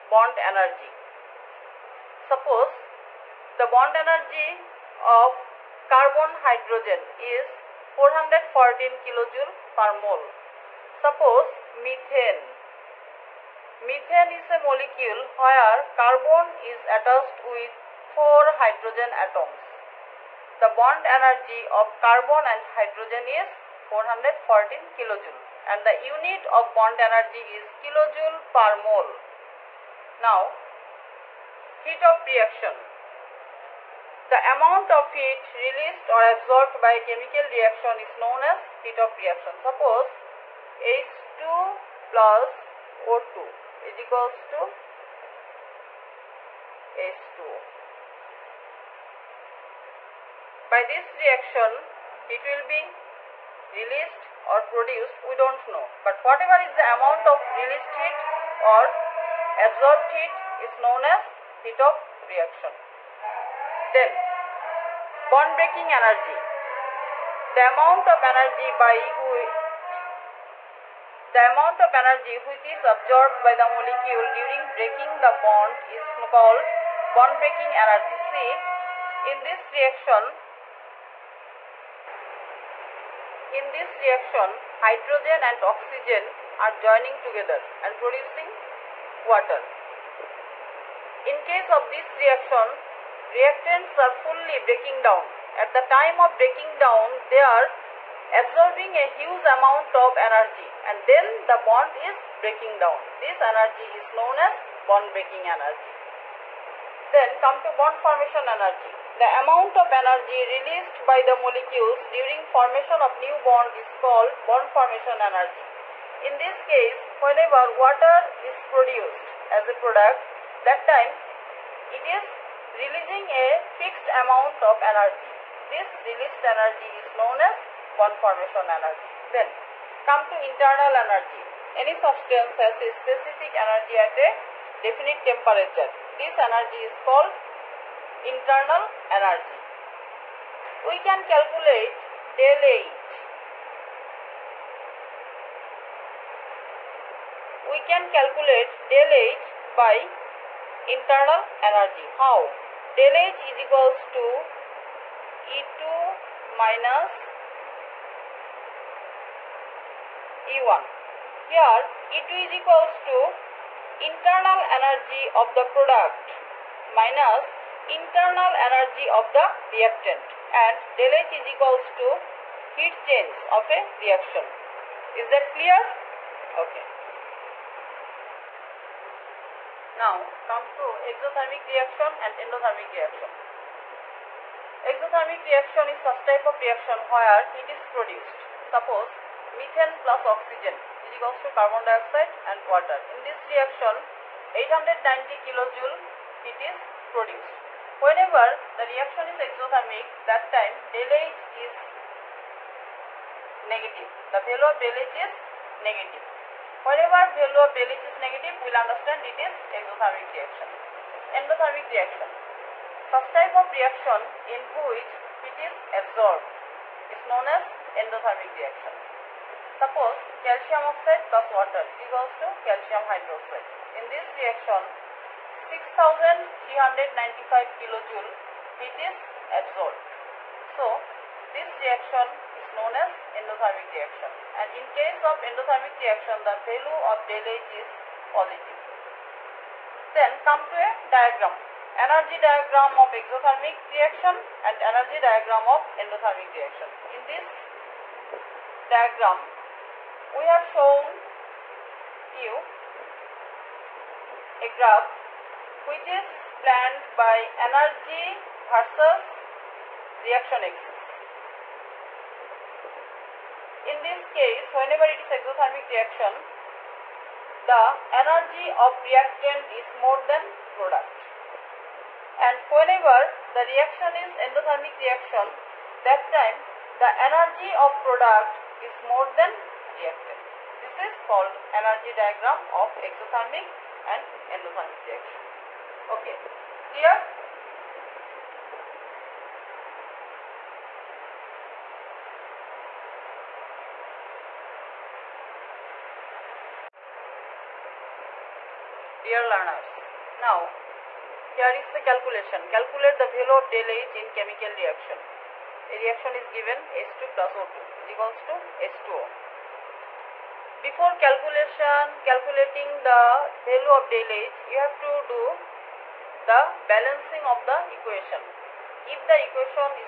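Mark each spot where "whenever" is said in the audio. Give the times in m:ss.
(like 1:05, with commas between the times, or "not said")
1:57, 3:17, 3:26, 4:24, 4:32.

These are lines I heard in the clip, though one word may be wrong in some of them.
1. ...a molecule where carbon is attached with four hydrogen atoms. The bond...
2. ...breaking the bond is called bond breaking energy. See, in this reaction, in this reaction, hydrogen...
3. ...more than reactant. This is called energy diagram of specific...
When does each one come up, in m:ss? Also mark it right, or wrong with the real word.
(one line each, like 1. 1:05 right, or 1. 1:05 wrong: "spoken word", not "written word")
1. 0:14 right
2. 1:14 right
3. 4:39 wrong: "exothermic", not "specific".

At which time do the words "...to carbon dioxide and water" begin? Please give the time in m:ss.
3:11.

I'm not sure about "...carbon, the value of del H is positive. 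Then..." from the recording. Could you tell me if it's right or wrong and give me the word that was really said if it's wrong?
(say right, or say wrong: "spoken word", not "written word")
wrong: "reaction", not "carbon".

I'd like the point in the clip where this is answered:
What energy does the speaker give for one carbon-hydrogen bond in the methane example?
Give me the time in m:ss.
0:07.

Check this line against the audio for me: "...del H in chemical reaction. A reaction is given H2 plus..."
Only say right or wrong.
right.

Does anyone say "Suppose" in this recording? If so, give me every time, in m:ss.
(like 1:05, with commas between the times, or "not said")
0:02, 0:10, 0:39, 3:08, 3:39.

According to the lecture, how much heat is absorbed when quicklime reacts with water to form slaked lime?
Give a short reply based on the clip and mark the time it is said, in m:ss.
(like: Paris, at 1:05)
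6395 kJ, at 3:45.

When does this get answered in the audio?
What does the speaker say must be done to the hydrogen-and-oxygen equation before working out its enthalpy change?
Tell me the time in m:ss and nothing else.
5:16.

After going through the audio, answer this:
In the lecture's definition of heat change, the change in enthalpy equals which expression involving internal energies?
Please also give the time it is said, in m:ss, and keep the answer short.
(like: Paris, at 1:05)
E2 minus E1, at 2:35.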